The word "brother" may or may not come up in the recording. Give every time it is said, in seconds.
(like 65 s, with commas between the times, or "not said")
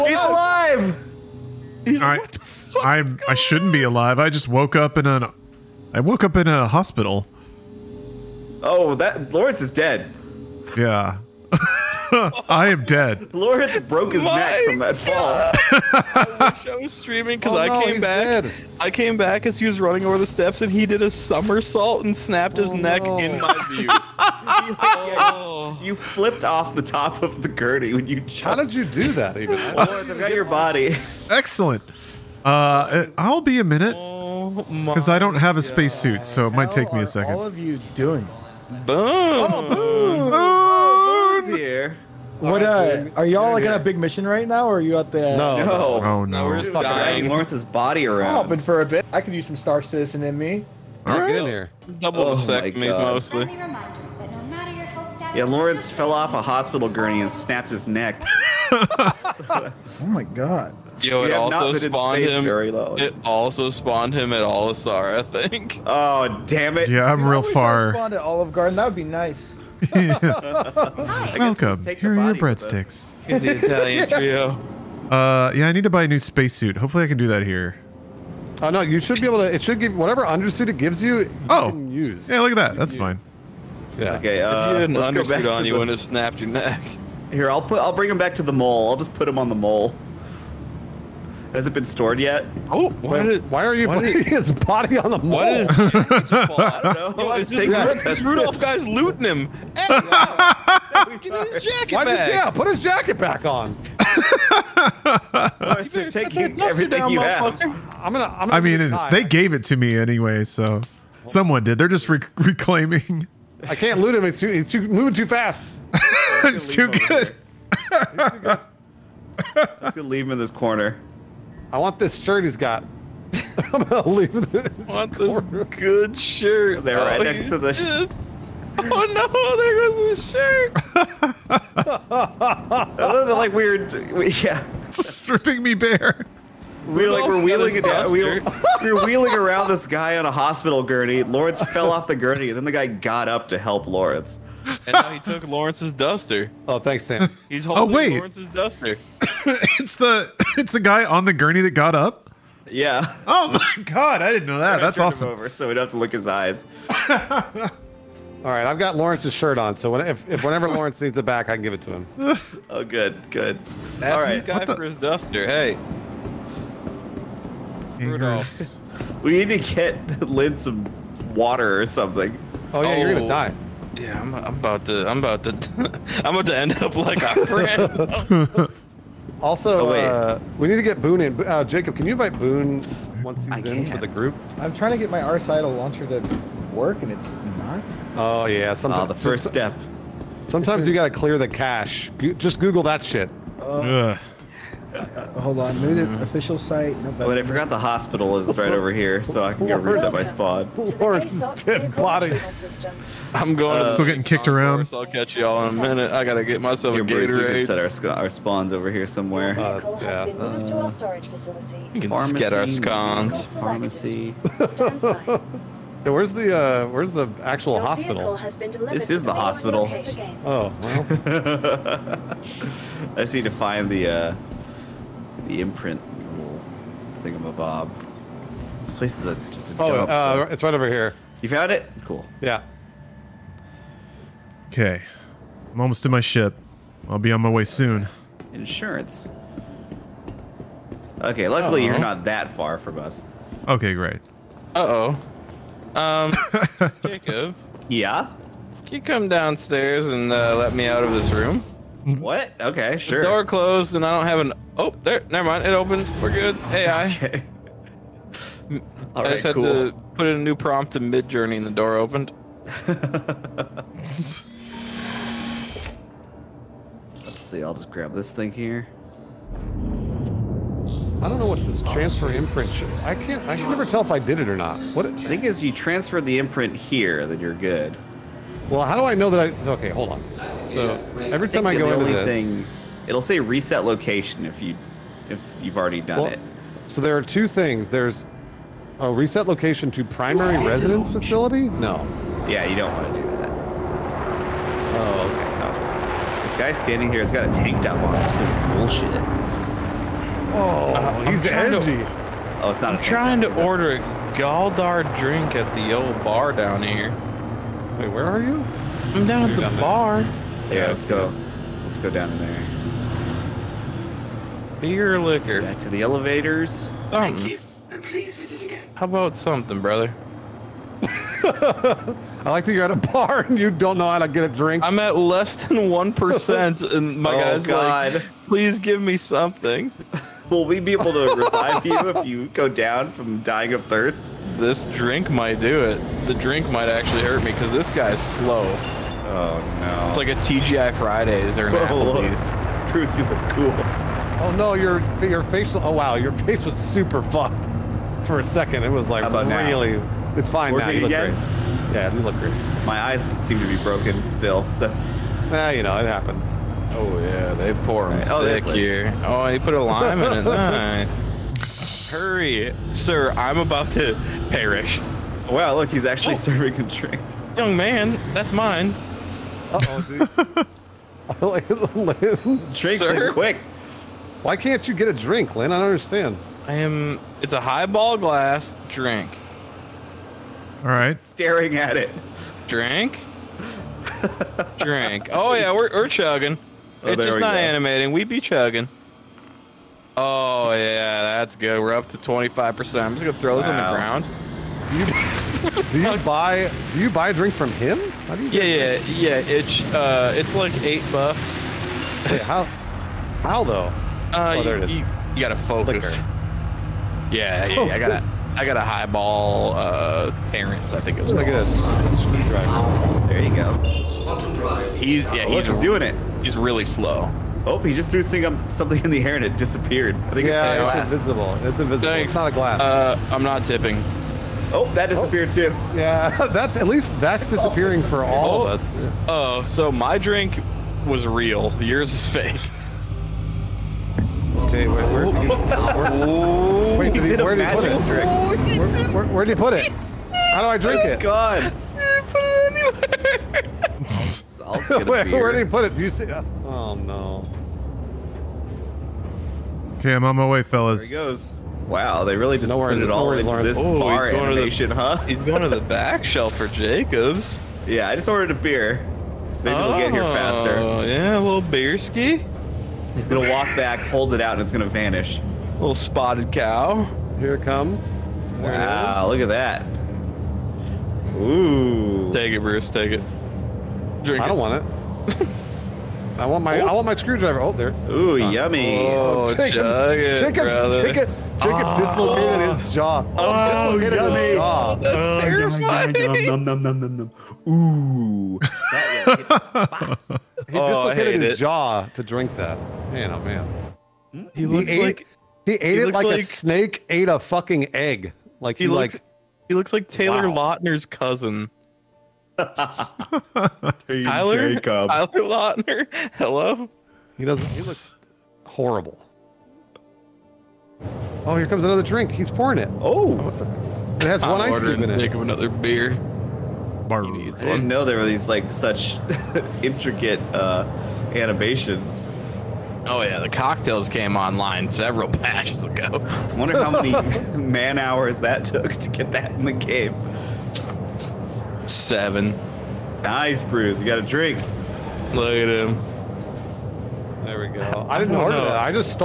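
319 s, 480 s.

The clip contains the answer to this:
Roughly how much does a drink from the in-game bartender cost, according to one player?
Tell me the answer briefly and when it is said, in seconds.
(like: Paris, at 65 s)
8 bucks, at 400 s.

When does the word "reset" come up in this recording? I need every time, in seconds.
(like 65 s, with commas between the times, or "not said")
199 s, 283 s, 289 s.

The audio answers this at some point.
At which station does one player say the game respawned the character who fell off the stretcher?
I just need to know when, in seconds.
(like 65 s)
64 s.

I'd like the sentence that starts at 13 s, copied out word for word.
Lawrence broke his My neck from that fall.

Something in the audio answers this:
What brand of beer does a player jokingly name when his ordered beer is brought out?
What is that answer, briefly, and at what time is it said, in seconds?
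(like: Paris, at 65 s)
Spotted Cow, at 465 s.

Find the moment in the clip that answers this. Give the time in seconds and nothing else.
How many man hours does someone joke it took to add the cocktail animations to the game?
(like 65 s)
531 s.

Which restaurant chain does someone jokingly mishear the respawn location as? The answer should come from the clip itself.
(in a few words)
Olive Garden.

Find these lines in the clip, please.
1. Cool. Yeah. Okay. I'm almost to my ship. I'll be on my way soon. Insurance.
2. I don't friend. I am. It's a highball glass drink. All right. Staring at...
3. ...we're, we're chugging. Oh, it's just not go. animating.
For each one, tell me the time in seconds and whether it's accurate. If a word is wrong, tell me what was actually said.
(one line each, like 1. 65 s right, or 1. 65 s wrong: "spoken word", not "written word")
1. 232 s right
2. 375 s wrong: "understand", not "friend"
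3. 385 s right.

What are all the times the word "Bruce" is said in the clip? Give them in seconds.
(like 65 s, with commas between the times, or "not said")
207 s, 342 s, 472 s, 533 s.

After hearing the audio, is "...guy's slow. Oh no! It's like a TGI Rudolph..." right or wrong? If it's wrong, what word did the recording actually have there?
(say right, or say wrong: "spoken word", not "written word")
wrong: "Fridays", not "Rudolph".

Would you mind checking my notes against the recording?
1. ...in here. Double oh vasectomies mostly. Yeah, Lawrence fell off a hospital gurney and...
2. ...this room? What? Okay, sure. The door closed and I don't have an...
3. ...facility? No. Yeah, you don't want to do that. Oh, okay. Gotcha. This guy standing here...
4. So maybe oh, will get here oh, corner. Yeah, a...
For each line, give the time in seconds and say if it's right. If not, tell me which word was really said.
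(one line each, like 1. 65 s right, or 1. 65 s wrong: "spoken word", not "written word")
1. 51 s right
2. 251 s right
3. 291 s right
4. 459 s wrong: "faster", not "corner".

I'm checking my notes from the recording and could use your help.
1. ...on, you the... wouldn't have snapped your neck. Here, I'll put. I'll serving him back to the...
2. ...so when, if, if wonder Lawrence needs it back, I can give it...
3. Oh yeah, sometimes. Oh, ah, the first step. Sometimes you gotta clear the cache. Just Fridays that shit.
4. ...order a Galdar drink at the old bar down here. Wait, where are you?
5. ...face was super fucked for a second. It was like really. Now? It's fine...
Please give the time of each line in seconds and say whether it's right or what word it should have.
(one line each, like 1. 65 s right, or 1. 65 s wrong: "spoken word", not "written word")
1. 85 s wrong: "bring", not "serving"
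2. 159 s wrong: "whenever", not "wonder"
3. 188 s wrong: "Google", not "Fridays"
4. 303 s right
5. 346 s right.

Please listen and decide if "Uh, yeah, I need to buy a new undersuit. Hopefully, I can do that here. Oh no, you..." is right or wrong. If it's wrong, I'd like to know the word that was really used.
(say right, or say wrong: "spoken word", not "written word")
wrong: "spacesuit", not "undersuit".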